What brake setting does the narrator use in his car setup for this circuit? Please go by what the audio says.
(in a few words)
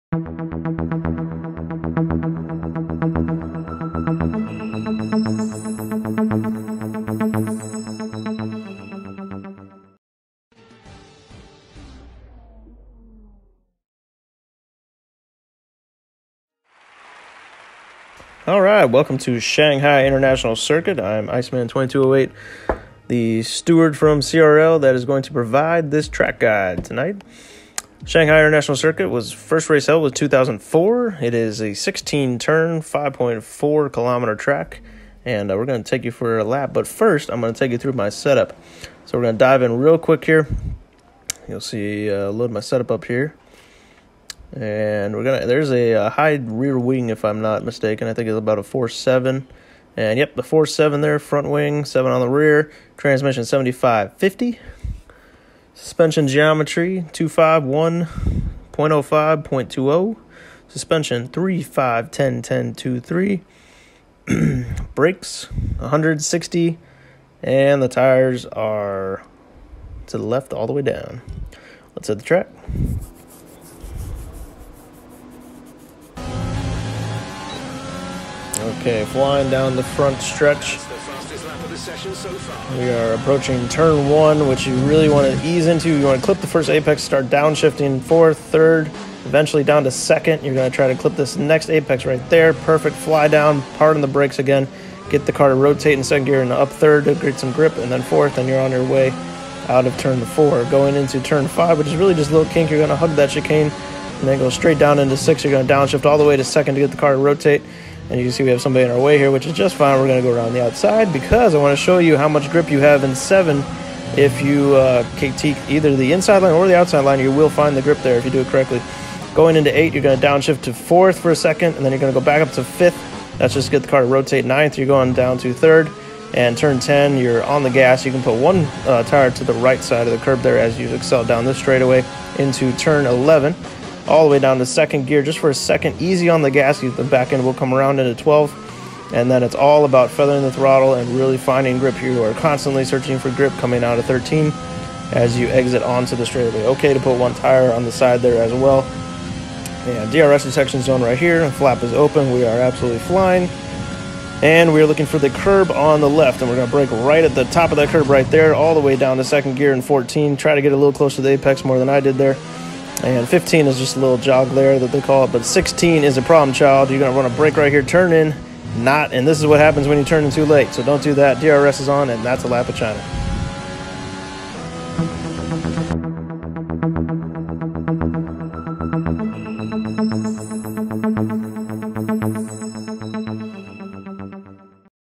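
160.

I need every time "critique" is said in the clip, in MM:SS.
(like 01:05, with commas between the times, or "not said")
01:55.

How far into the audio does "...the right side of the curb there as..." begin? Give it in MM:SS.
02:09.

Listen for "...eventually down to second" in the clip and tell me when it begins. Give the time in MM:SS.
01:29.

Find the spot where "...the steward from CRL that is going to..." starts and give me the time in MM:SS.
00:23.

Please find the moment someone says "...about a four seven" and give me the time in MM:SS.
00:48.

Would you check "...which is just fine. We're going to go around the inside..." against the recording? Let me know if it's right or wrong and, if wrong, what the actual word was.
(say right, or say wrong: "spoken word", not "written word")
wrong: "outside", not "inside".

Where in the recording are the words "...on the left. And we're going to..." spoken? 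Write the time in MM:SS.
02:35.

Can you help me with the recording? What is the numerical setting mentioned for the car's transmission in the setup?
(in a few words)
75 50.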